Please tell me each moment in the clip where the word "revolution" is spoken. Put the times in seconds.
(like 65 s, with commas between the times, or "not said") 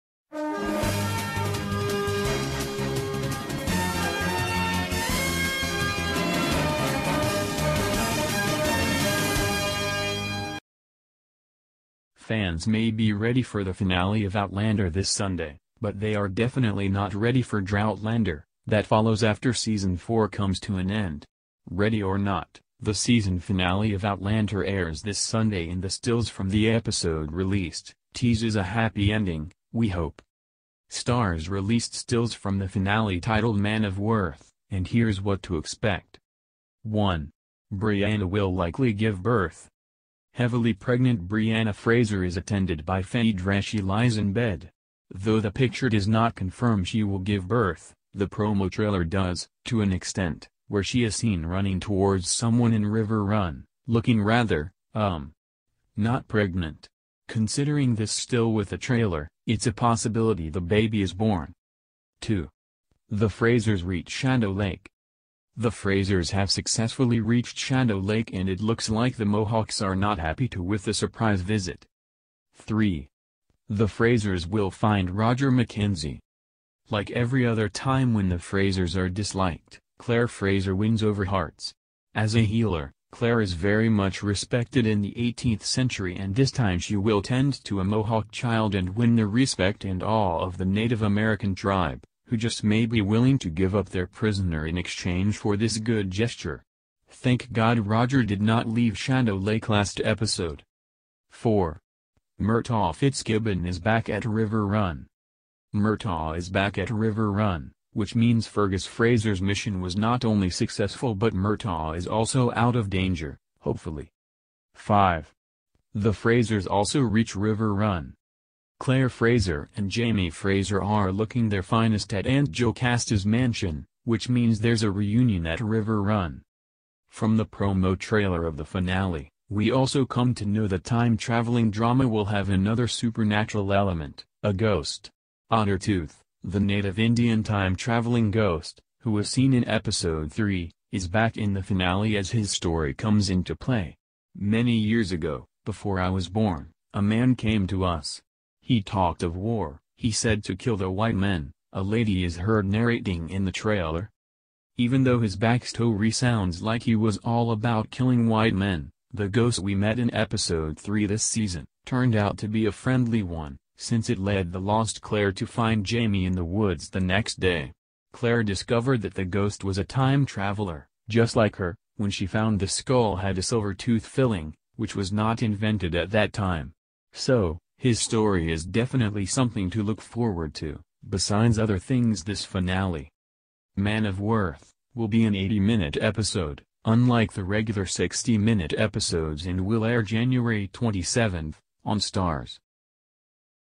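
not said.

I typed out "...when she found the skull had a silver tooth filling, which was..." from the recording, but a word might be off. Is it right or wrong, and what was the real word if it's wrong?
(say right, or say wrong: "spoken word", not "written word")
right.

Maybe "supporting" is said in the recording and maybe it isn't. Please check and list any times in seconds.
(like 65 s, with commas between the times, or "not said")
not said.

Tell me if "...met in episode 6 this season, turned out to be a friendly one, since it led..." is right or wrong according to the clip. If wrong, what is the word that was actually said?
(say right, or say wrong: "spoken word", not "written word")
wrong: "3", not "6".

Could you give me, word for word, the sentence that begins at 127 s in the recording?
From the promo trailer of the finale, we also come to know the time-traveling drama will have another supernatural element, a ghost.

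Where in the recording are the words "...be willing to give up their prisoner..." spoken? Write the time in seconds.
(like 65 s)
92 s.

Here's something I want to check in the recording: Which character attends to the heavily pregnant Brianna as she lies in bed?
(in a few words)
Phaedra.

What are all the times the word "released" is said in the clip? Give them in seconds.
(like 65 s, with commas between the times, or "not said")
27 s, 31 s.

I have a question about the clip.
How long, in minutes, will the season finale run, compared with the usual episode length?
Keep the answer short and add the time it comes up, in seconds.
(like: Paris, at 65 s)
80, at 185 s.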